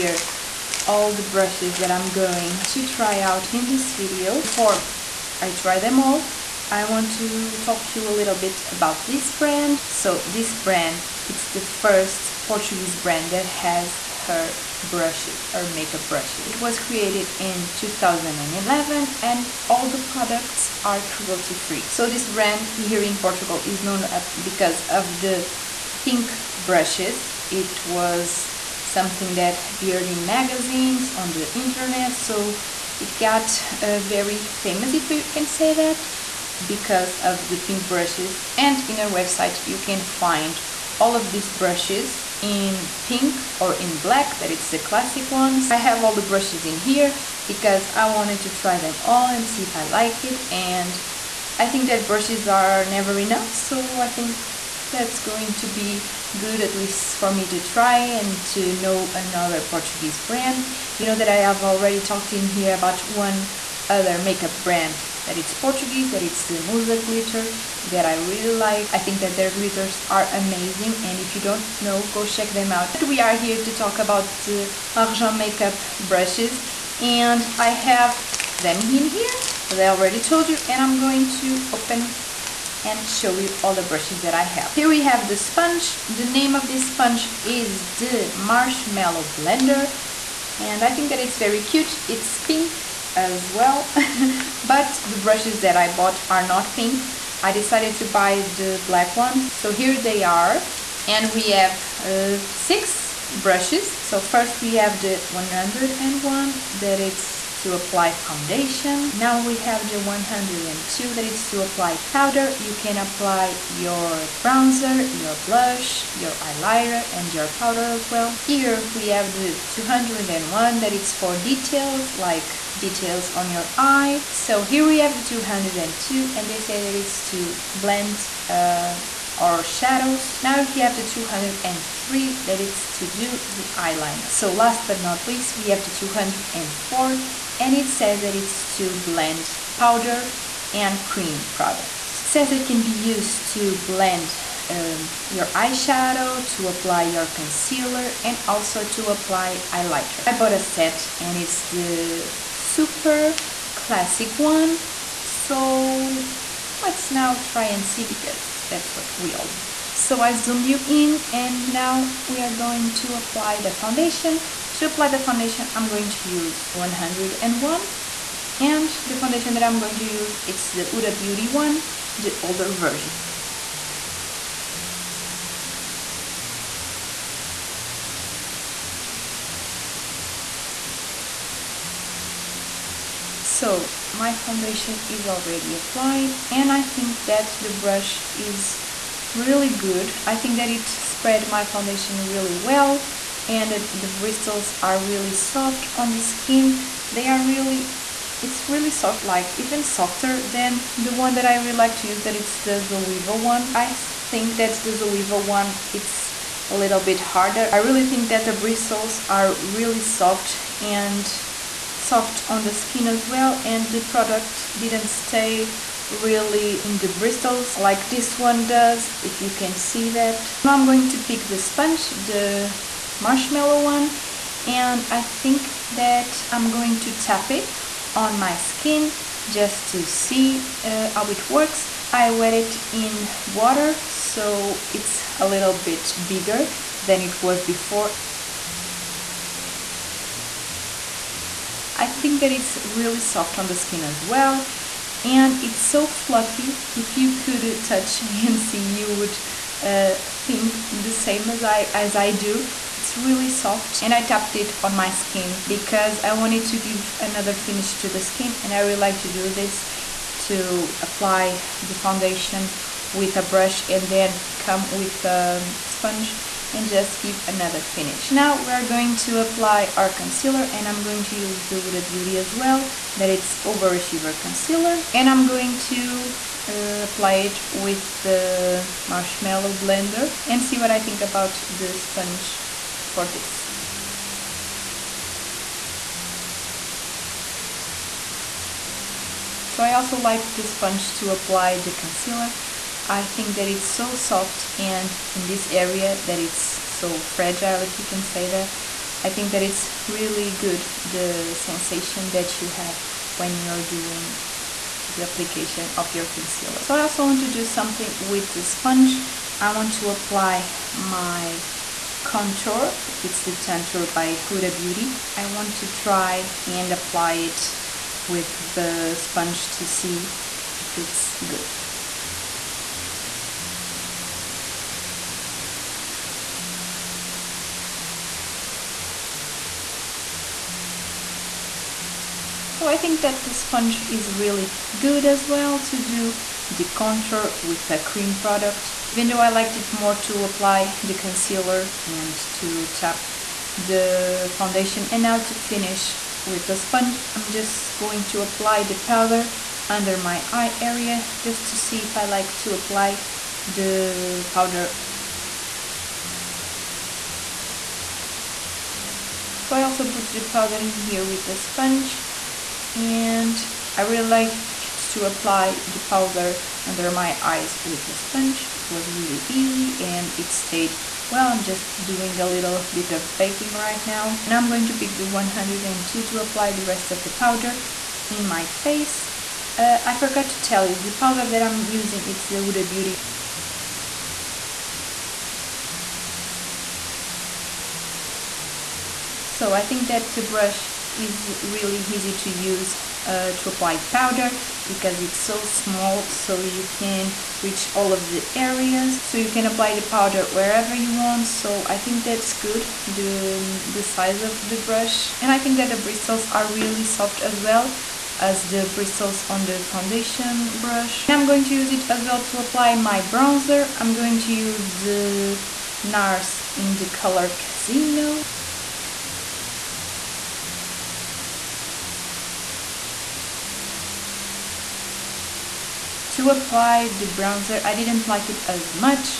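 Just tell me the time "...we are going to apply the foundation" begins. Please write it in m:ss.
2:42.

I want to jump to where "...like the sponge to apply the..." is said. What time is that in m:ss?
4:50.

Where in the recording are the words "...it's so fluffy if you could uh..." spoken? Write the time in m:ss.
4:05.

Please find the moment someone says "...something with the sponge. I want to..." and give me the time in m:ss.
5:07.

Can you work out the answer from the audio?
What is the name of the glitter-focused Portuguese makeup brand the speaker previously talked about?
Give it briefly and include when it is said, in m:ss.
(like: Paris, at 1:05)
Musa, at 1:06.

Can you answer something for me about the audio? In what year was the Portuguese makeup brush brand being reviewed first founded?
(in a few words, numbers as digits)
2011.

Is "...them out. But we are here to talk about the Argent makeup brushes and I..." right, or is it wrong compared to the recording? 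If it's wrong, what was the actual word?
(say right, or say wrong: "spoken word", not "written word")
right.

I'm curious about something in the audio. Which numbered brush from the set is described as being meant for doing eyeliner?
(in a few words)
203.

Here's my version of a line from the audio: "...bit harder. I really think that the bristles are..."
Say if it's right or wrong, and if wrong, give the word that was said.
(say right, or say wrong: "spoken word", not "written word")
right.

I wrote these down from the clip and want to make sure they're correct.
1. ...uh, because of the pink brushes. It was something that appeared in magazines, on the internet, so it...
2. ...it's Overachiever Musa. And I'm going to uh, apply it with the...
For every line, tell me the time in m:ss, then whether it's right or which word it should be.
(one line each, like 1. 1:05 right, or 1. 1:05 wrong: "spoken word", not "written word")
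1. 0:24 right
2. 4:33 wrong: "Concealer", not "Musa".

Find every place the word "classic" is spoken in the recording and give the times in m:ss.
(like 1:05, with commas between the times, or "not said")
0:44, 2:33.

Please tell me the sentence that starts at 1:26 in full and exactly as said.
The name of this sponge is the Marshmallow Blender and I think that it's very cute.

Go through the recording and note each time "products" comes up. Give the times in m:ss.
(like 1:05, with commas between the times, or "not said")
0:19, 2:21, 3:33, 5:38.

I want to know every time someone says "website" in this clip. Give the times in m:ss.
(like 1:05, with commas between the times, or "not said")
0:39.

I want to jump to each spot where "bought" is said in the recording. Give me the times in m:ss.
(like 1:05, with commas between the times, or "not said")
1:35, 2:30.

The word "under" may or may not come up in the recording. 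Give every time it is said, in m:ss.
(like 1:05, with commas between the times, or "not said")
5:49, 6:06.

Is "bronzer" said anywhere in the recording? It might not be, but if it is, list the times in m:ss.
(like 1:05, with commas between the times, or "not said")
1:54, 6:53, 7:07.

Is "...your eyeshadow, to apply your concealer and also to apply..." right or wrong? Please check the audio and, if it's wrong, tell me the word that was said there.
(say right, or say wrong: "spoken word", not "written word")
right.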